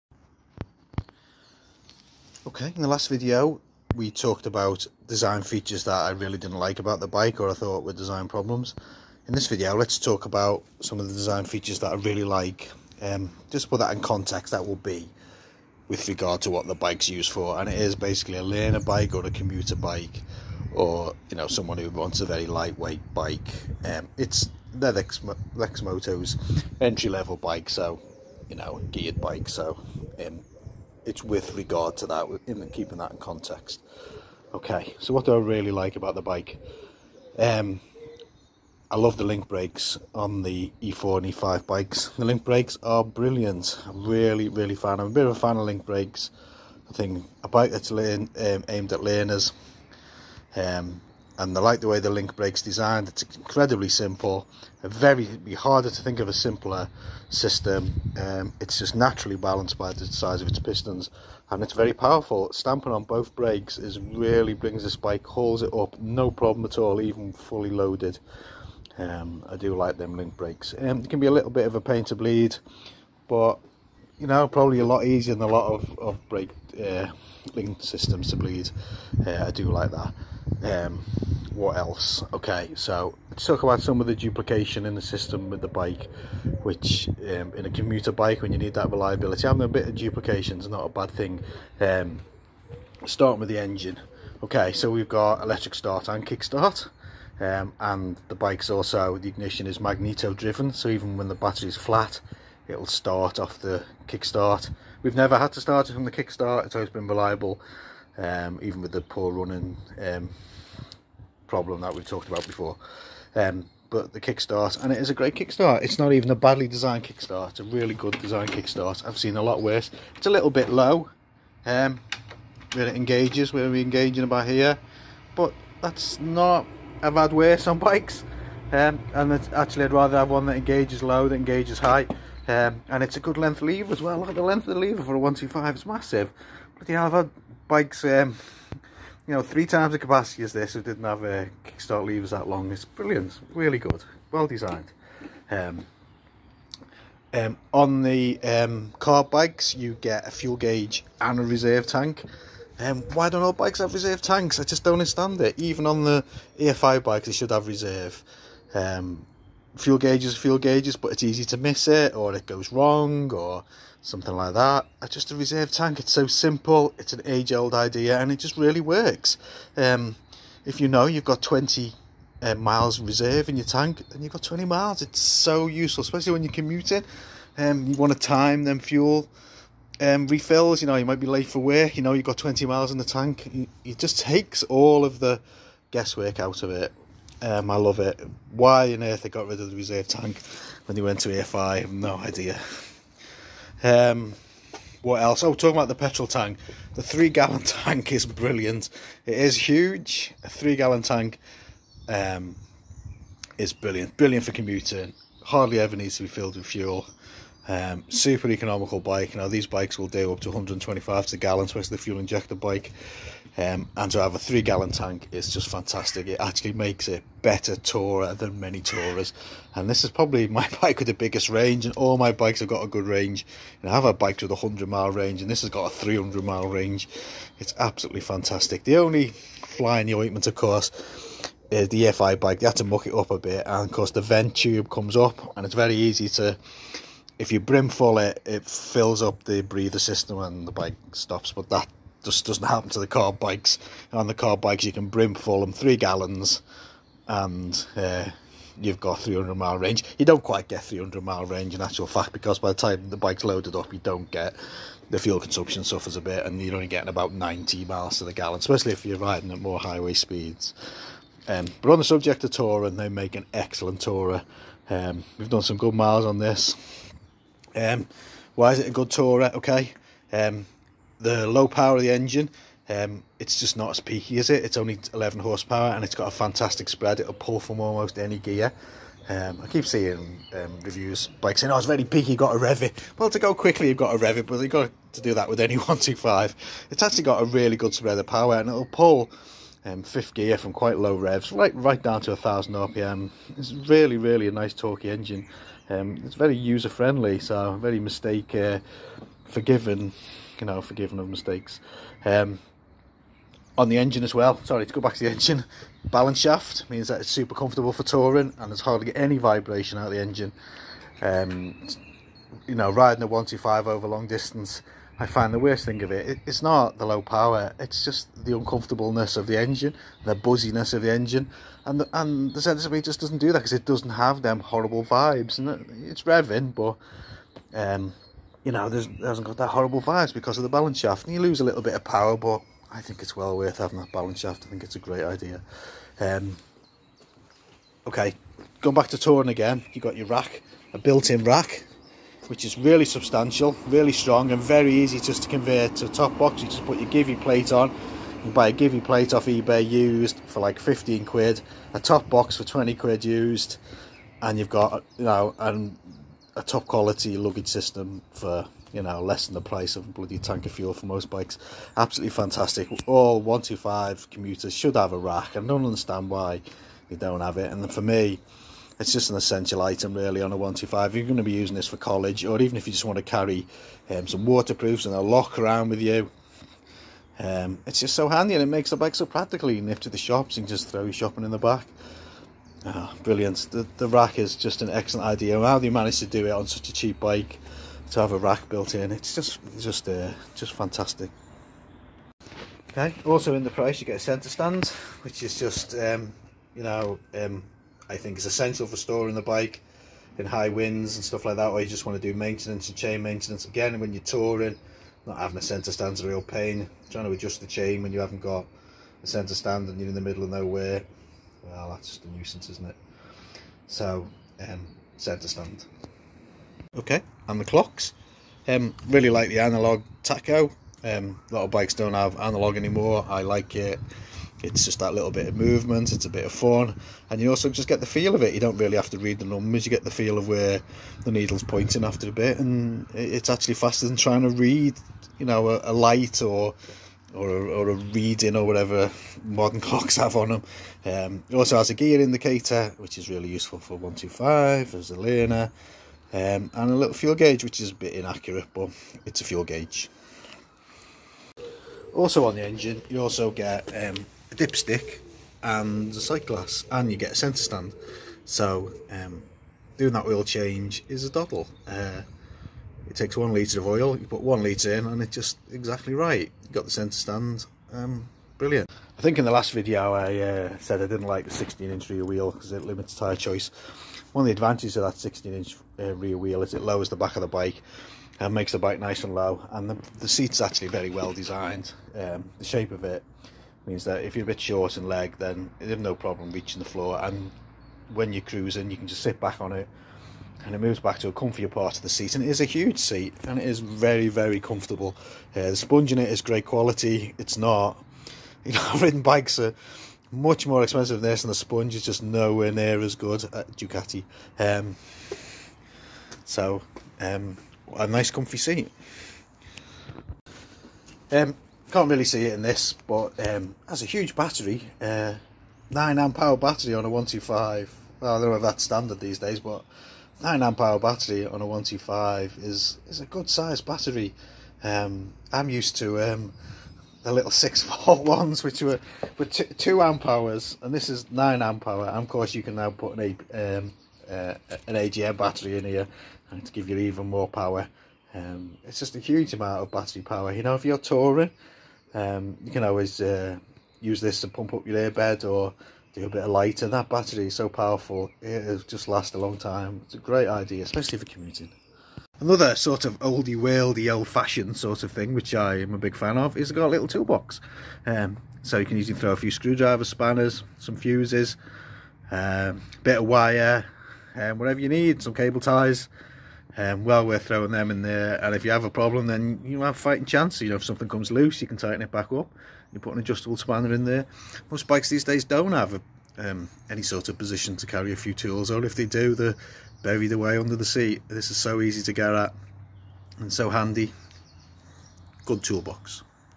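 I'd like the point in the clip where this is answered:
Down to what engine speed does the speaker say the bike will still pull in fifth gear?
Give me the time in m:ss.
4:52.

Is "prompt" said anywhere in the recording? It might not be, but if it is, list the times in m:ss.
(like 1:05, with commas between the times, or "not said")
not said.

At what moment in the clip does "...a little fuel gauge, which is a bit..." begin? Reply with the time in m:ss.
7:26.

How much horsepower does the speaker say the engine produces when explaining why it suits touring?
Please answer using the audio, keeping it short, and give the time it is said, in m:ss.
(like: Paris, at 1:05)
11, at 4:35.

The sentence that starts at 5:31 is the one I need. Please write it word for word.
And you lose a little bit of power, but I think it's well worth having that balance shaft.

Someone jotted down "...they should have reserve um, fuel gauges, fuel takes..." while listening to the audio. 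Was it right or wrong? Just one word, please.
wrong.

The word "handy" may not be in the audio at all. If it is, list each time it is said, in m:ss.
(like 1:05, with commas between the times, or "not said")
6:18, 9:43.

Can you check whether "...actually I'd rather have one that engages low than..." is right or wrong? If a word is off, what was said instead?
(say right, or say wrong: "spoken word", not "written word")
right.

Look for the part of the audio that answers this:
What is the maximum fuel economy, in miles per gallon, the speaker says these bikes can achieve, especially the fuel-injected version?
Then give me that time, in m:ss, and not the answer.
3:30.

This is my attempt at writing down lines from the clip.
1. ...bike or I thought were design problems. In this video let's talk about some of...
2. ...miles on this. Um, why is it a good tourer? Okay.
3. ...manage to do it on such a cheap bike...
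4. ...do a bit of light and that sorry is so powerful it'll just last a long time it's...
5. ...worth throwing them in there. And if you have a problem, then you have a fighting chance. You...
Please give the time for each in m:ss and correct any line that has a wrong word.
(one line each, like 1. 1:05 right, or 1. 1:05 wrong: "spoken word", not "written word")
1. 0:07 right
2. 4:25 right
3. 6:25 right
4. 9:06 wrong: "battery", not "sorry"
5. 9:27 right.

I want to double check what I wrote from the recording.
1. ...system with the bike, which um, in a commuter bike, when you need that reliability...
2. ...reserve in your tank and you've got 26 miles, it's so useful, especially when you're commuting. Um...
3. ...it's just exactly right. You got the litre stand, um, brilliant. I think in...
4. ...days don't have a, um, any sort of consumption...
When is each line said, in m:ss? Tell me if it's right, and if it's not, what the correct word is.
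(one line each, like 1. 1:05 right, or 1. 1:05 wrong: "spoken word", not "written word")
1. 1:25 right
2. 2:52 wrong: "20", not "26"
3. 7:45 wrong: "centre", not "litre"
4. 9:35 wrong: "position", not "consumption".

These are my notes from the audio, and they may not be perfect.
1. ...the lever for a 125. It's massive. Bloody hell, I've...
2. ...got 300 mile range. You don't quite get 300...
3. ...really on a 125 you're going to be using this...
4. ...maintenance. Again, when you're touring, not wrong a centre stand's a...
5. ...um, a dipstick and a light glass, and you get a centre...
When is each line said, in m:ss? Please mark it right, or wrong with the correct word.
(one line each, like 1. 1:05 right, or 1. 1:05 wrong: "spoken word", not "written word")
1. 2:14 right
2. 4:08 right
3. 6:10 right
4. 6:43 wrong: "having", not "wrong"
5. 7:33 wrong: "sight", not "light".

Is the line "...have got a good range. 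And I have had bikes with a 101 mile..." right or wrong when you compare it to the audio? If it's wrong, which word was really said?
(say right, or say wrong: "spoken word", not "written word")
wrong: "100", not "101".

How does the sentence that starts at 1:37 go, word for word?
Um, and the bike's also, the ignition is magneto driven, so even when the battery's flat, it'll start off the kickstart.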